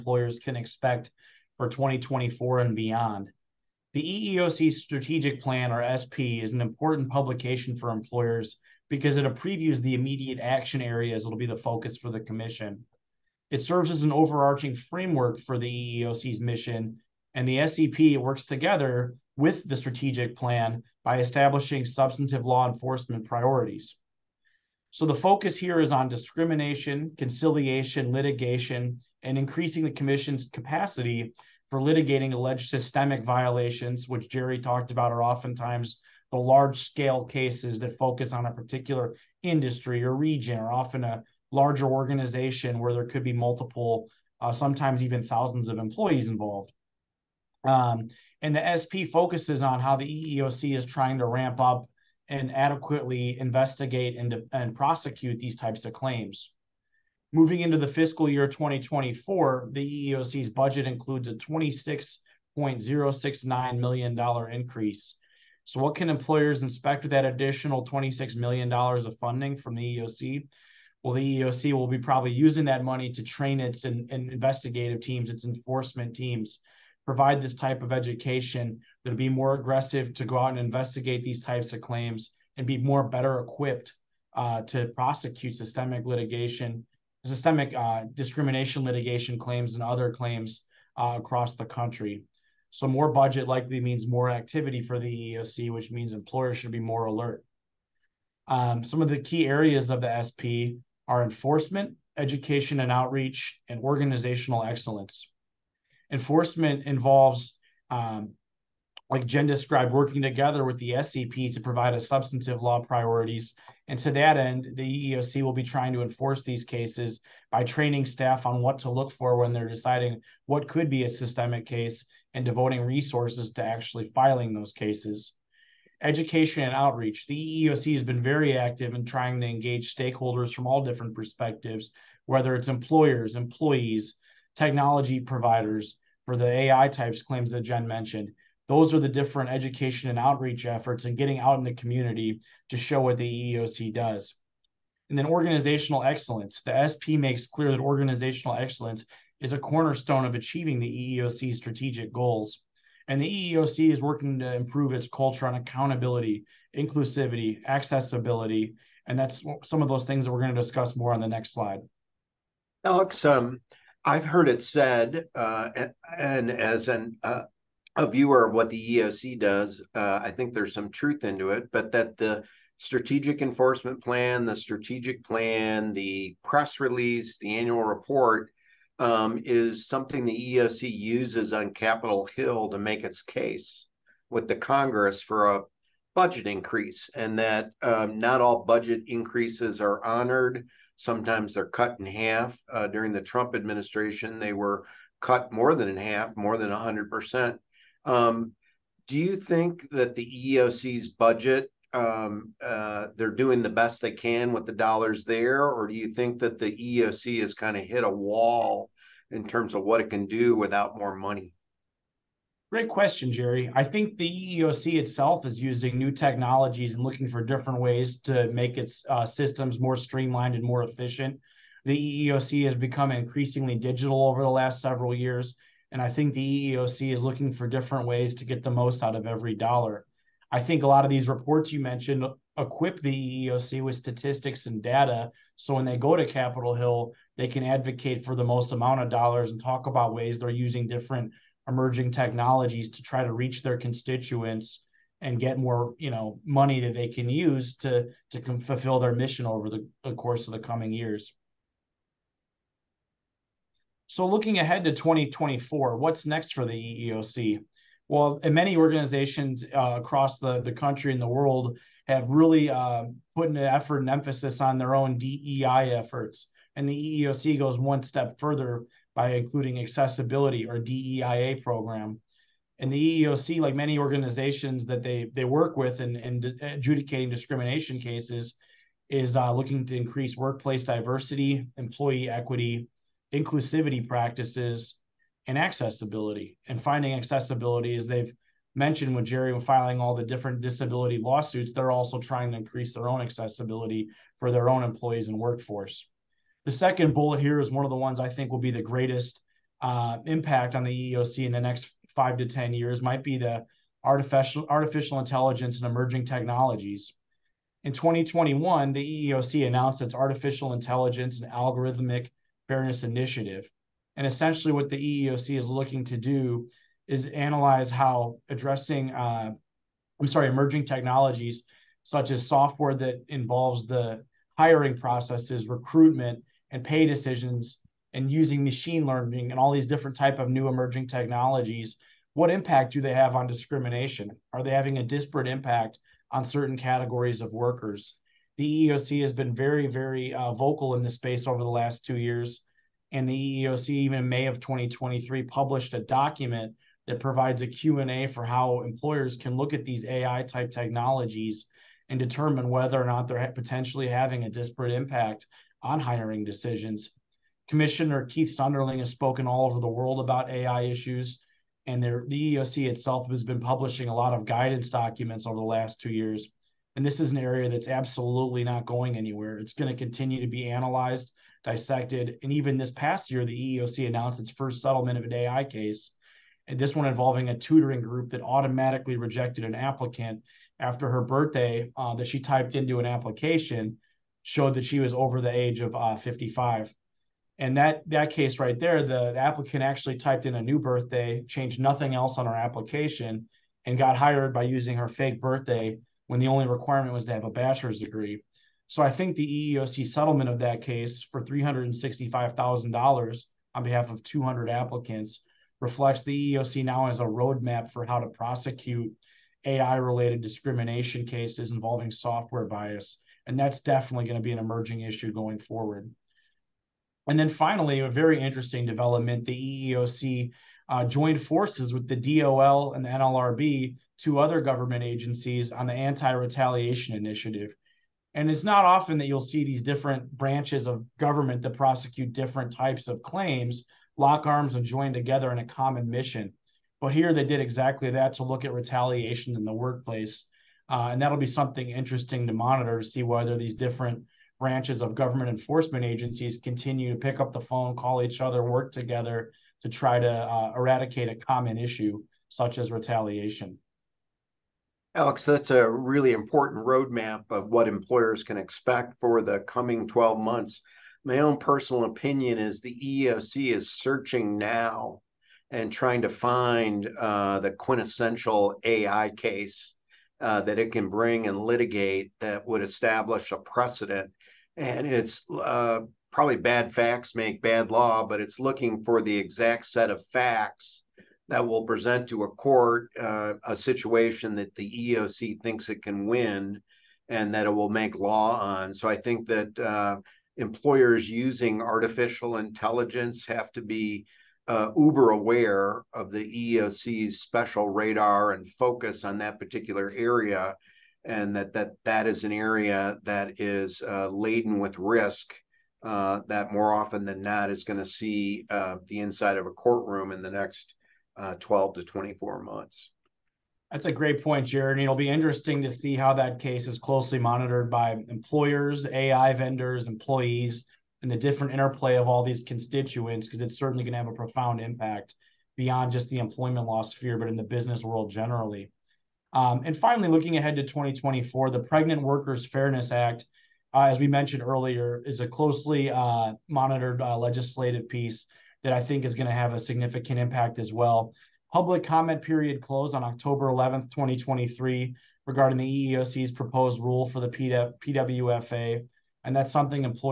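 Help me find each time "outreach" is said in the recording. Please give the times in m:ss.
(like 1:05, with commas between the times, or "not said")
1:42, 2:06, 2:20.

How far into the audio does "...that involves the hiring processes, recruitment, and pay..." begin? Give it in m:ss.
5:22.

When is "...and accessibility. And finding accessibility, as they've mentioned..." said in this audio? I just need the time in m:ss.
4:45.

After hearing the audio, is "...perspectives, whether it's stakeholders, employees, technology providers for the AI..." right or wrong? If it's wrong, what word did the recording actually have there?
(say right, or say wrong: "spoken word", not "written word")
wrong: "employers", not "stakeholders".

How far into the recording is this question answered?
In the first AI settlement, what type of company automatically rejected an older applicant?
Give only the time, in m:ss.
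6:17.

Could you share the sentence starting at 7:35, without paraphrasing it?
Alex, that's a really important roadmap of what employers can expect for the coming 12 months.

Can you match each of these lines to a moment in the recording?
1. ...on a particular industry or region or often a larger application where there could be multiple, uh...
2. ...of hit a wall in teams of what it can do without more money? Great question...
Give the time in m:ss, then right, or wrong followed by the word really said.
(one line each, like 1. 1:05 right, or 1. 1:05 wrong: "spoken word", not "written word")
1. 0:38 wrong: "organization", not "application"
2. 3:27 wrong: "terms", not "teams".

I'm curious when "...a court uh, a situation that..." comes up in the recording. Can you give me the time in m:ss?
8:02.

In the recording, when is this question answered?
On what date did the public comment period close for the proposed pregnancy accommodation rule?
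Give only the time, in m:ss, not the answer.
9:03.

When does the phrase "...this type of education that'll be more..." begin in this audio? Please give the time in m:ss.
1:17.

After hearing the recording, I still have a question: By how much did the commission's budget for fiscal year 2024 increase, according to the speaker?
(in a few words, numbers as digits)
$26.069 million.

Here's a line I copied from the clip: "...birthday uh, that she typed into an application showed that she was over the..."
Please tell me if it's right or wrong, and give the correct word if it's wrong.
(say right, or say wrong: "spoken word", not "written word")
right.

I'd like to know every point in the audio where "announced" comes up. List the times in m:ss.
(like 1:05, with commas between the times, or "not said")
5:09, 6:14.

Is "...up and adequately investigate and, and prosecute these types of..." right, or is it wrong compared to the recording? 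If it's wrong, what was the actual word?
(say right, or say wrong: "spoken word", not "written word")
right.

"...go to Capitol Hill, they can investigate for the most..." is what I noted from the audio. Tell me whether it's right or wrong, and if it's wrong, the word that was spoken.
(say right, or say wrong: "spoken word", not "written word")
wrong: "advocate", not "investigate".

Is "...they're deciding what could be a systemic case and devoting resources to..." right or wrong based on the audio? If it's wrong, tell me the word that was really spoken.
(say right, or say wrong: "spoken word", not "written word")
right.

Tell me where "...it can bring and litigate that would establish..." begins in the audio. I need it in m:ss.
7:50.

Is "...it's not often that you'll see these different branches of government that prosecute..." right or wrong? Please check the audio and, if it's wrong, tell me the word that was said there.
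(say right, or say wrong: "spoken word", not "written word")
right.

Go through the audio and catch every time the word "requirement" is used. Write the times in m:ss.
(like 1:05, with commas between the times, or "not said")
6:36.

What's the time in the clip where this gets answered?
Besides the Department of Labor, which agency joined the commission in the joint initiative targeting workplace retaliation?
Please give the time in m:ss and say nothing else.
7:03.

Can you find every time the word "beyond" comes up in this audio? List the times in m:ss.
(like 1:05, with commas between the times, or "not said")
0:02, 8:45.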